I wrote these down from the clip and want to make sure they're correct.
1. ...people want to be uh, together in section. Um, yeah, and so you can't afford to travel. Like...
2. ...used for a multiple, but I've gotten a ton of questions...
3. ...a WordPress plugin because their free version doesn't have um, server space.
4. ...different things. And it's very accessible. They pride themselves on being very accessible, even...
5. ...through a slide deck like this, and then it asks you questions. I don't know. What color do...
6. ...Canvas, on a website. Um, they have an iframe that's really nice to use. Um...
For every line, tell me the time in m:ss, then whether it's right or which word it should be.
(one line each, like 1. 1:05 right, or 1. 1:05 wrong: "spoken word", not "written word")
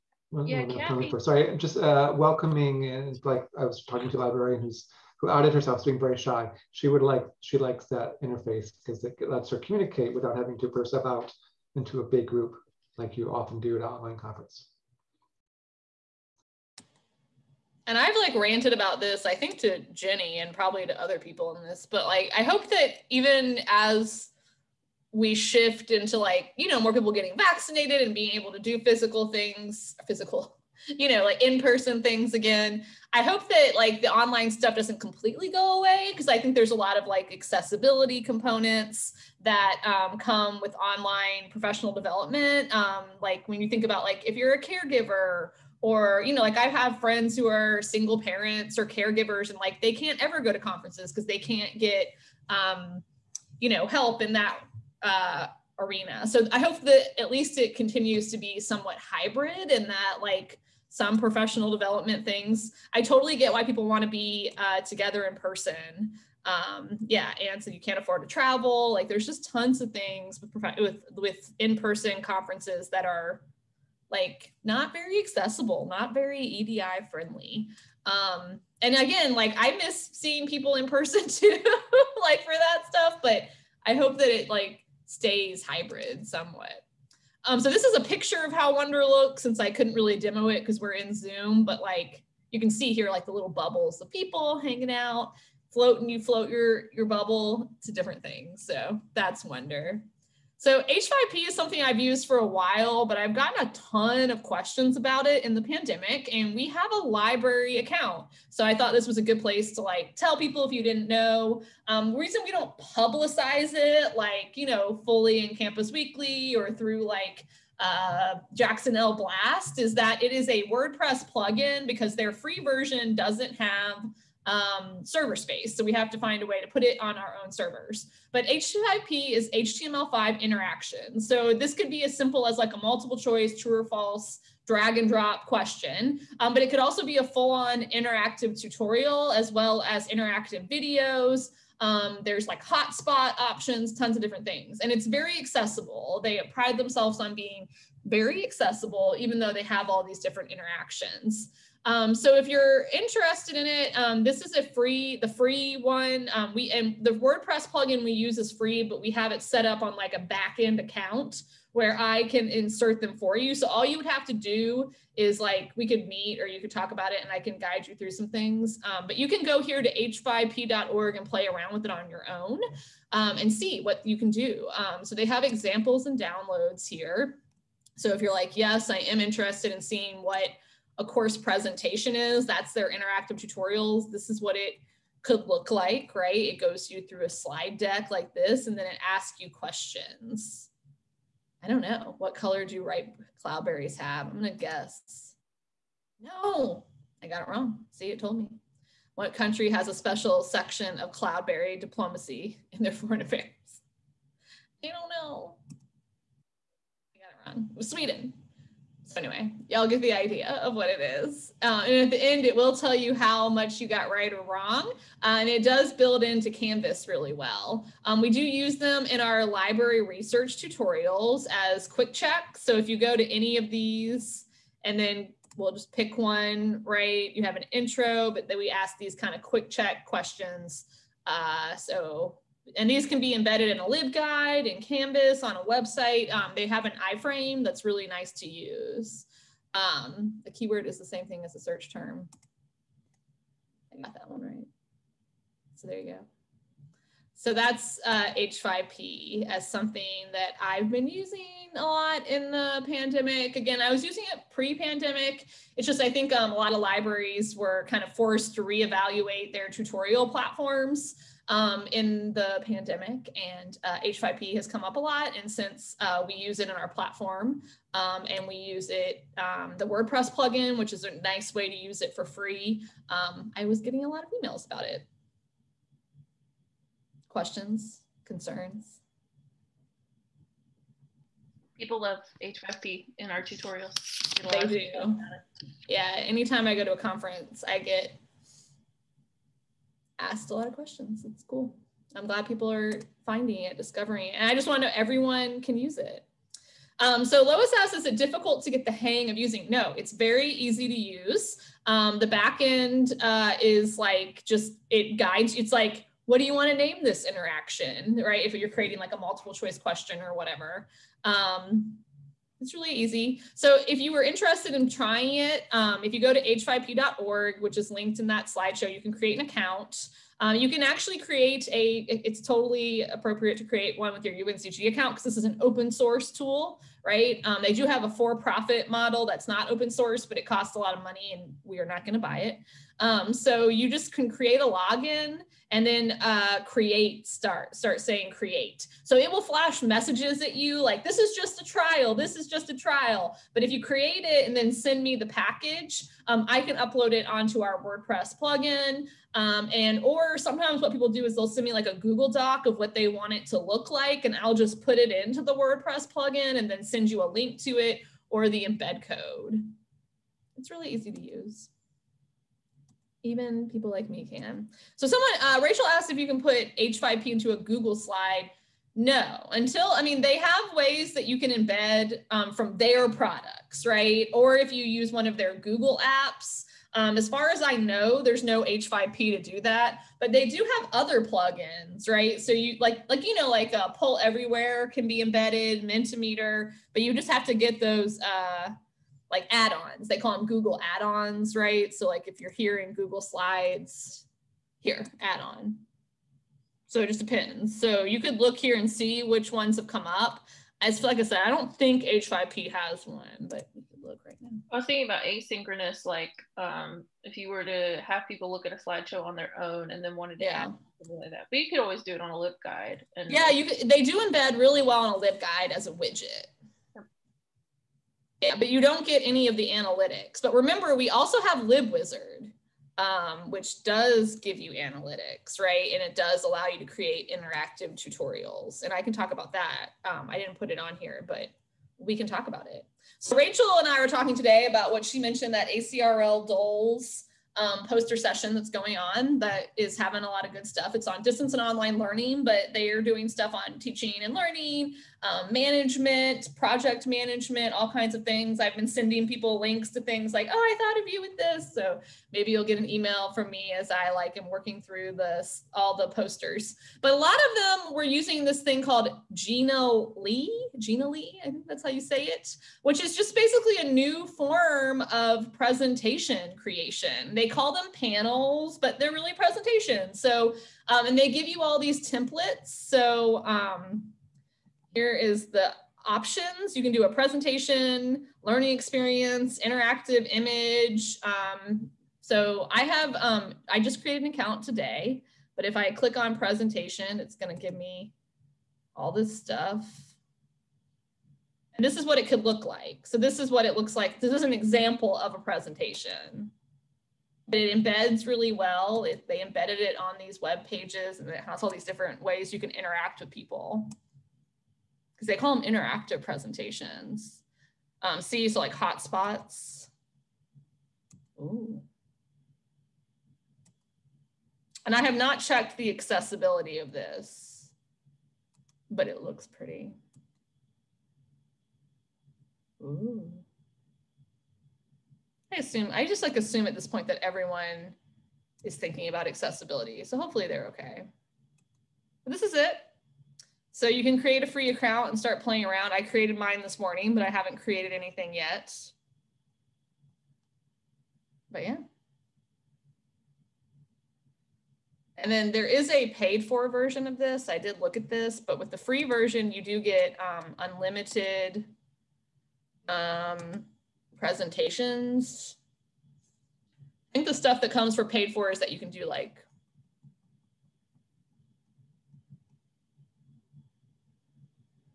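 1. 1:03 wrong: "person", not "section"
2. 1:41 wrong: "while", not "multiple"
3. 2:00 right
4. 2:24 right
5. 3:07 right
6. 3:54 right.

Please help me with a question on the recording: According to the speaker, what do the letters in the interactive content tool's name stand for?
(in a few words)
HTML5 interaction.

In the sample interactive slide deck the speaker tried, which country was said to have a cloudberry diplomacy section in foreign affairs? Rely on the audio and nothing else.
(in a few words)
Sweden.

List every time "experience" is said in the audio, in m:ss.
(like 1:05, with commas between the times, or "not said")
7:58.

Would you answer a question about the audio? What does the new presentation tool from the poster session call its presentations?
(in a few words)
panels.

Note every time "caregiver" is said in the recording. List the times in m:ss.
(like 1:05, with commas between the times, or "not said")
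0:44, 0:48.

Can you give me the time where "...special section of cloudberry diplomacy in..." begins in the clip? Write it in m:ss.
3:19.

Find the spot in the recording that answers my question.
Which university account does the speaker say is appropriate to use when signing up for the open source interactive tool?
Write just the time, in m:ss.
5:24.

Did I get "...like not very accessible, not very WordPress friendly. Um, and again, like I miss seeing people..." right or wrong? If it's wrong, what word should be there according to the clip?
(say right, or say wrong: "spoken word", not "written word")
wrong: "EDI", not "WordPress".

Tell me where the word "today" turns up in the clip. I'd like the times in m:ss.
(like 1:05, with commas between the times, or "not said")
7:14, 8:04.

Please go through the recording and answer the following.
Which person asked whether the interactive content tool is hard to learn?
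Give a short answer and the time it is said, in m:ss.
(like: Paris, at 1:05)
Lois, at 4:57.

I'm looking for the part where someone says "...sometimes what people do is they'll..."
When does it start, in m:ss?
5:50.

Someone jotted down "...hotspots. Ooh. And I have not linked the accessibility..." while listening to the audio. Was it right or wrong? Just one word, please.
wrong.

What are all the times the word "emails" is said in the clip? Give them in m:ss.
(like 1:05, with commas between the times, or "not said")
4:34, 7:32.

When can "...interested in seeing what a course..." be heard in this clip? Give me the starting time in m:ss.
2:59.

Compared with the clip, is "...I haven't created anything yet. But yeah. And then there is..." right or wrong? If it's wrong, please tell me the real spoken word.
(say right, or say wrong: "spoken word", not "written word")
right.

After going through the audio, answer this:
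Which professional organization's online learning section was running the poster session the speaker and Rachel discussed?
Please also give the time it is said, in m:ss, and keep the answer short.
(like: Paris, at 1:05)
ACRL DOLS, at 7:15.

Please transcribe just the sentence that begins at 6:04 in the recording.
So someone, uh, Rachel asked if you can put H5P into a Google slide.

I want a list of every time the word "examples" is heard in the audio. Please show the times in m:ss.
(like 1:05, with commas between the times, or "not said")
2:55, 8:14.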